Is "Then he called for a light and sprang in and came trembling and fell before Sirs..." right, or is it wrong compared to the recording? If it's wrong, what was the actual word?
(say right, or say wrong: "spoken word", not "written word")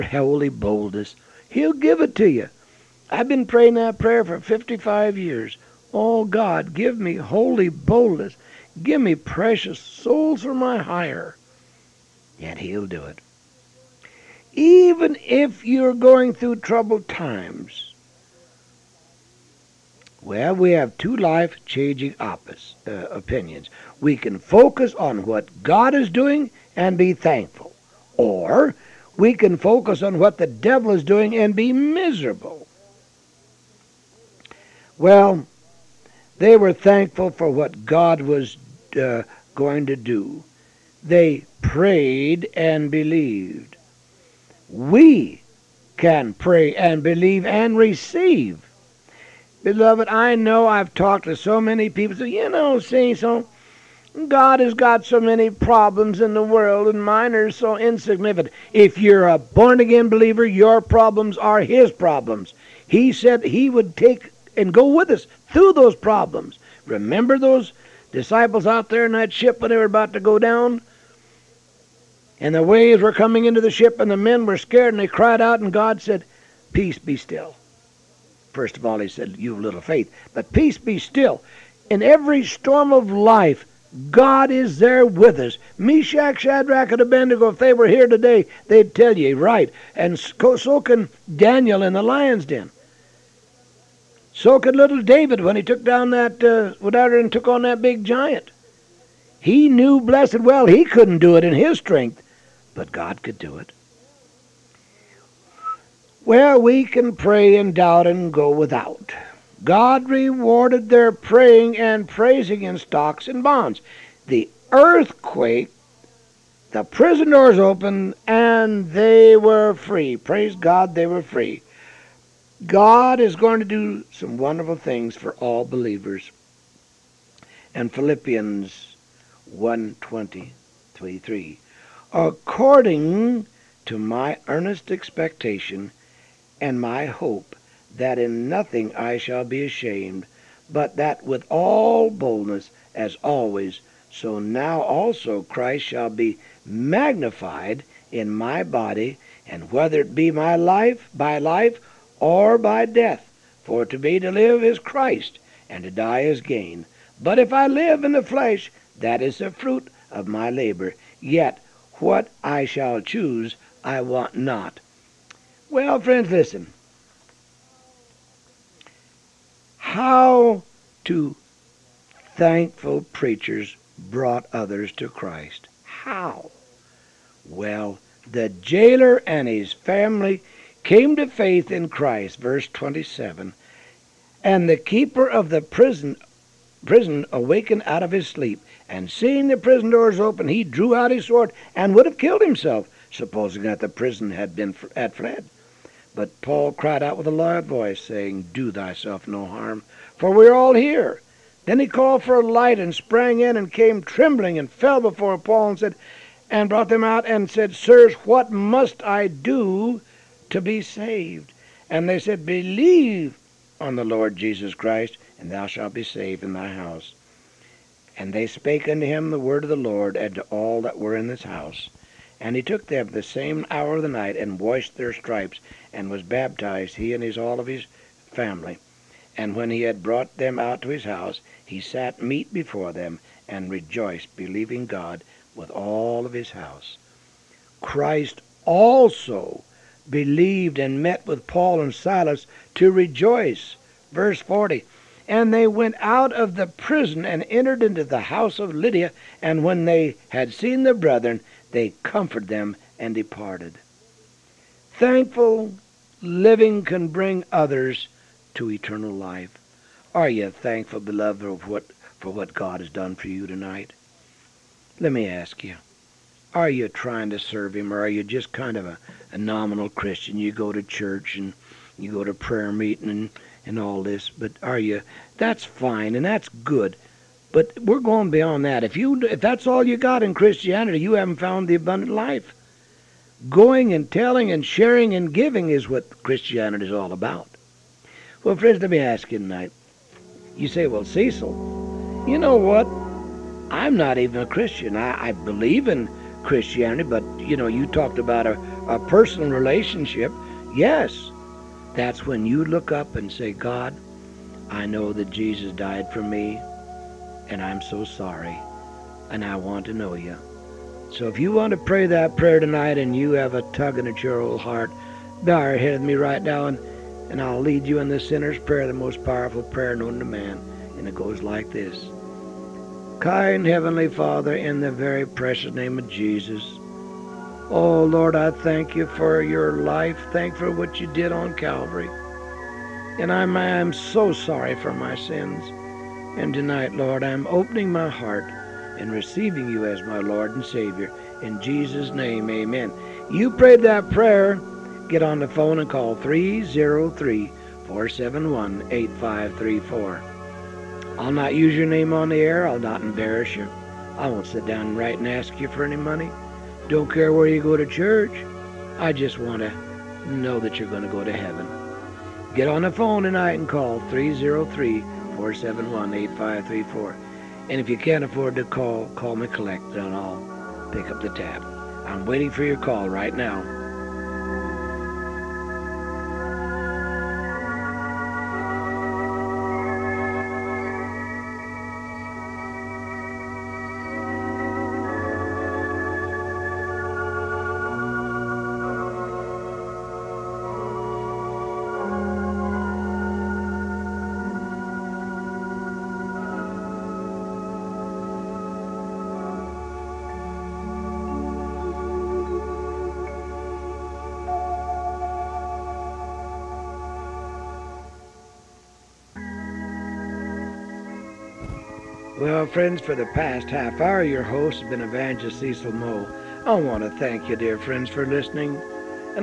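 wrong: "Paul", not "Sirs".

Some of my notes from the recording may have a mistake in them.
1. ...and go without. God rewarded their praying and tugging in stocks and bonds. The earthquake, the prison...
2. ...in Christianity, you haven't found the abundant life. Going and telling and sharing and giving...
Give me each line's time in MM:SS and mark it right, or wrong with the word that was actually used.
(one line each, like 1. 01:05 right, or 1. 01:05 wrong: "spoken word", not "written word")
1. 01:48 wrong: "praising", not "tugging"
2. 04:40 right.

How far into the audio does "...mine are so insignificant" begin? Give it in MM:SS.
00:57.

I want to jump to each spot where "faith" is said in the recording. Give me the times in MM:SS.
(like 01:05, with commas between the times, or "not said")
01:19, 03:01.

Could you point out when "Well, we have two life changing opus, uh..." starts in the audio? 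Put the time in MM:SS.
00:20.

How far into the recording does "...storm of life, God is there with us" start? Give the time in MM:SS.
01:22.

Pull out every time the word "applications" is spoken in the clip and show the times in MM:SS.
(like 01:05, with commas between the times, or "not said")
not said.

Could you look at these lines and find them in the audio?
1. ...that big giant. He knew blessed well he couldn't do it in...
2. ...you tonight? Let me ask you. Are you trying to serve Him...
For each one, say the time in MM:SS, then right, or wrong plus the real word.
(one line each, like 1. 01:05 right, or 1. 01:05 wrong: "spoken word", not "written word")
1. 01:37 right
2. 04:23 right.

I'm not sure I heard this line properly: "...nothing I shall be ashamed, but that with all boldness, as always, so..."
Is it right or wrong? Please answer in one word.
right.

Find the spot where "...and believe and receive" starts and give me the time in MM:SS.
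00:46.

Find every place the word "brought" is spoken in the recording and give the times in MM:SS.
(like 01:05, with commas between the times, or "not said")
02:53, 03:26, 03:50.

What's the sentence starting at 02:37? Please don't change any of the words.
But if I live in the flesh, that is the fruit of my labor.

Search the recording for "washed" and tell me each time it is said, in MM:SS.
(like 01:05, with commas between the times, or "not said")
03:44.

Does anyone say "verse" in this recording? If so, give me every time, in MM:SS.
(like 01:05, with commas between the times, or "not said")
03:02, 04:04.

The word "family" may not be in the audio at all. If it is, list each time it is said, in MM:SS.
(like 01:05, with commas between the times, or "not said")
02:59, 03:48.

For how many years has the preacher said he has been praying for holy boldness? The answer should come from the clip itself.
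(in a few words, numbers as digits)
55.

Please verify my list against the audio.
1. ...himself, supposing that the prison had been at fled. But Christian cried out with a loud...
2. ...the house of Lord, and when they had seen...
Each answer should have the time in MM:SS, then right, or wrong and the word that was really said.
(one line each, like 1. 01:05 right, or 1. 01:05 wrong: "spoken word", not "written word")
1. 03:12 wrong: "Paul", not "Christian"
2. 04:08 wrong: "Lydia", not "Lord".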